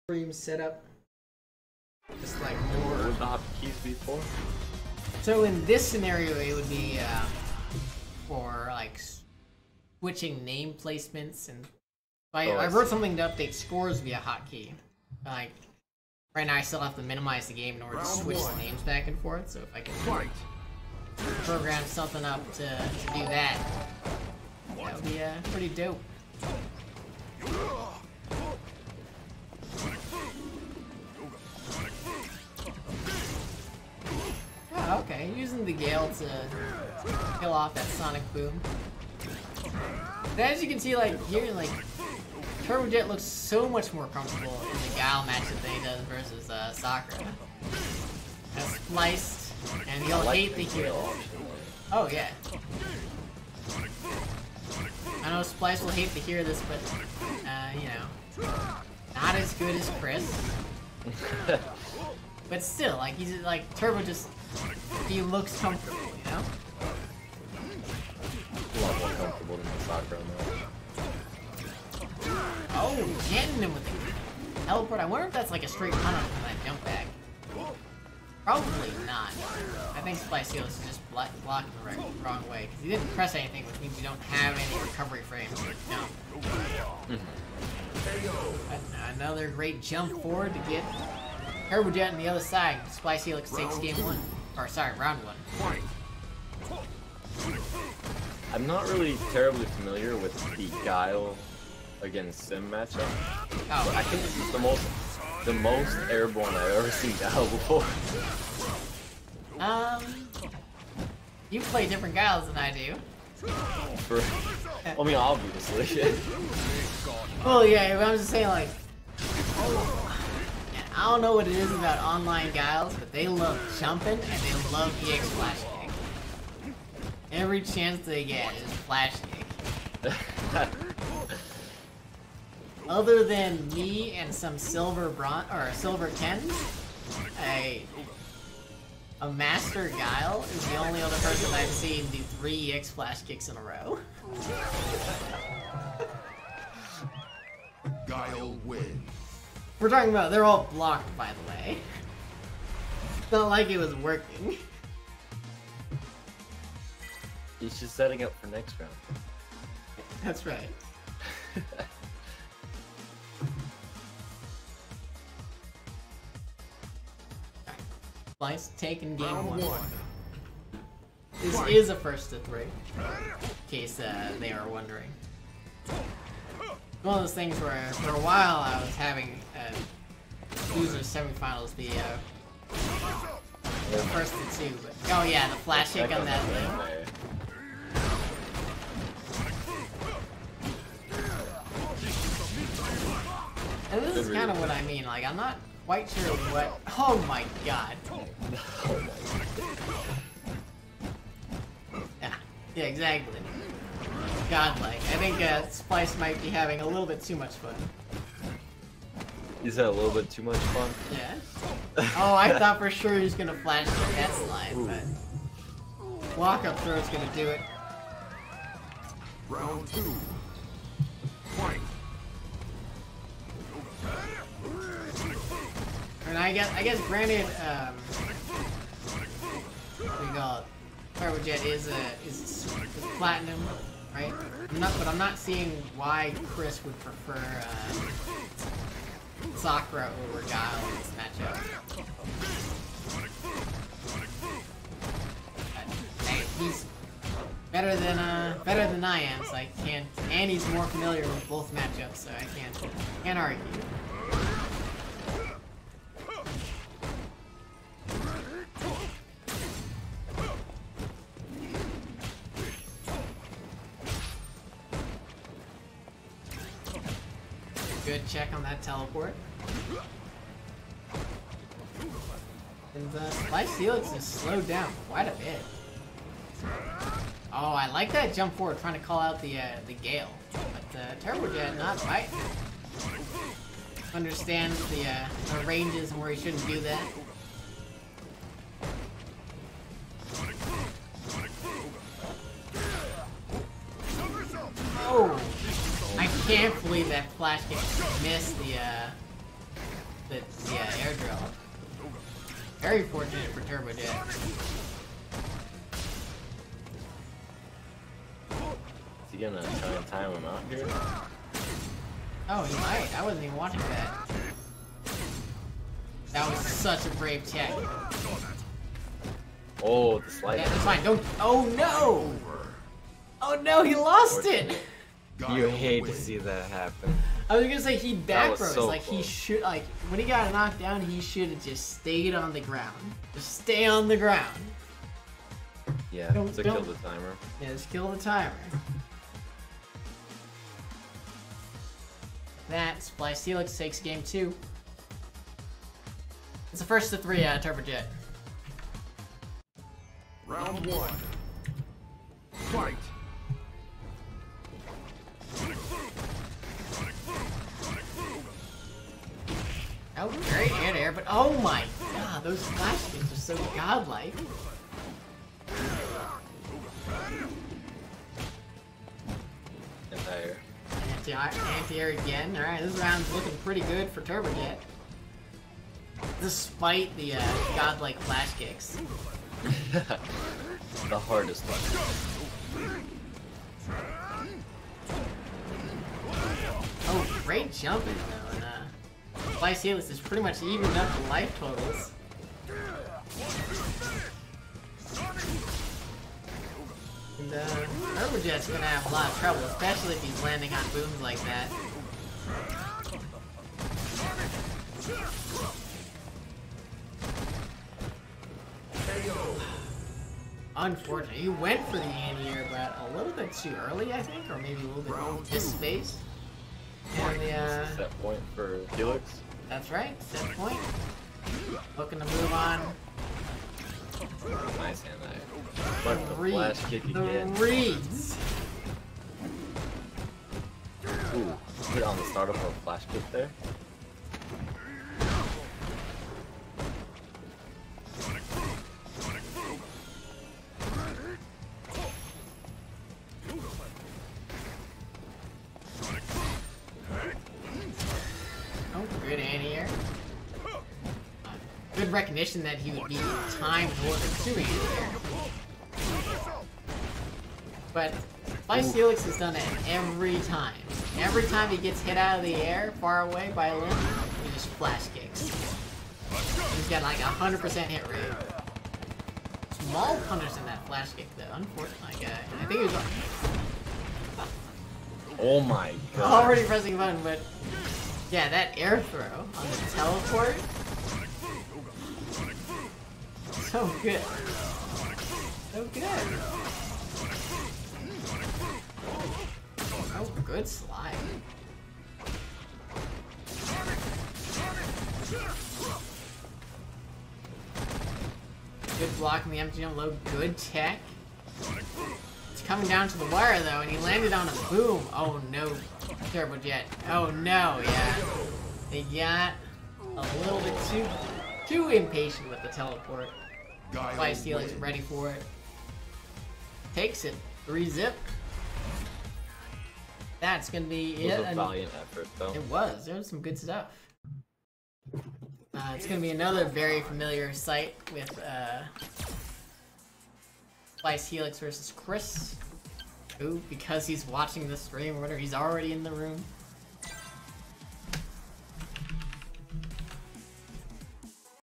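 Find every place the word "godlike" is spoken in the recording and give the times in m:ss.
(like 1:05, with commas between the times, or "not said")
3:24, 6:03, 6:17.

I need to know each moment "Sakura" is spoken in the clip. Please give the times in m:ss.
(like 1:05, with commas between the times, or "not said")
0:46, 1:09, 3:59.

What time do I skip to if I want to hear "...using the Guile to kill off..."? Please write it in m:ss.
0:35.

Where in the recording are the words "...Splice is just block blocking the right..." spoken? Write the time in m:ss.
1:20.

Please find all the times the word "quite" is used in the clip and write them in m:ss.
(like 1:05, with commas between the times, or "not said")
3:15, 4:35.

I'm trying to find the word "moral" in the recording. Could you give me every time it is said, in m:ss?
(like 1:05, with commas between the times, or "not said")
not said.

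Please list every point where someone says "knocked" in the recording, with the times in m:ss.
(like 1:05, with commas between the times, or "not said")
5:30.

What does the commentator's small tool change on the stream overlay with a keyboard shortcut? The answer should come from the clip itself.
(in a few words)
Scores.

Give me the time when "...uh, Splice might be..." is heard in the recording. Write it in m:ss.
3:25.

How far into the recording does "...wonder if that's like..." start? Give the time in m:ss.
1:15.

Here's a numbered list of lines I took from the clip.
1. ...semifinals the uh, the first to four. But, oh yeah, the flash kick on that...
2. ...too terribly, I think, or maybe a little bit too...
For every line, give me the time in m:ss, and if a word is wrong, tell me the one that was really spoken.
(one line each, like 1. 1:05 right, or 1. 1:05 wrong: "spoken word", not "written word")
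1. 3:00 wrong: "two", not "four"
2. 6:53 wrong: "early", not "terribly".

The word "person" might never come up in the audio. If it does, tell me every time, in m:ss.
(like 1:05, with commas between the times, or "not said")
2:21.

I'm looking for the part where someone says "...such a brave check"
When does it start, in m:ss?
5:16.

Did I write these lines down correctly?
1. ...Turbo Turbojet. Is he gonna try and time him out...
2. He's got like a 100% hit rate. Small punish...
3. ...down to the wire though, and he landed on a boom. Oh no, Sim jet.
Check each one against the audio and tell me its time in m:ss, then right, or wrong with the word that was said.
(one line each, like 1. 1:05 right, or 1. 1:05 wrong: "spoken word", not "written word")
1. 5:03 right
2. 7:46 right
3. 8:22 wrong: "Terrible", not "Sim".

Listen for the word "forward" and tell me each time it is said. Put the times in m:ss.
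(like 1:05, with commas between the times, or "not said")
1:30, 4:38.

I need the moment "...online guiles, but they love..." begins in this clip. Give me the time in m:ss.
2:02.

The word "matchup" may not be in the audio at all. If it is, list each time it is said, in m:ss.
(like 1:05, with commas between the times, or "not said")
0:45, 1:42, 4:01, 4:11.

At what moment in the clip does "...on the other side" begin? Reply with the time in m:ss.
1:32.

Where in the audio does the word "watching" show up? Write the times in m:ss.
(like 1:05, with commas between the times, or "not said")
5:13, 8:54.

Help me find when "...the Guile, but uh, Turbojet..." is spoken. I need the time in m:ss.
4:39.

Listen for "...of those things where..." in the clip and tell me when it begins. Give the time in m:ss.
2:57.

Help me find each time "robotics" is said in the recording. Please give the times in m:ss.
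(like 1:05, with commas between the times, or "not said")
not said.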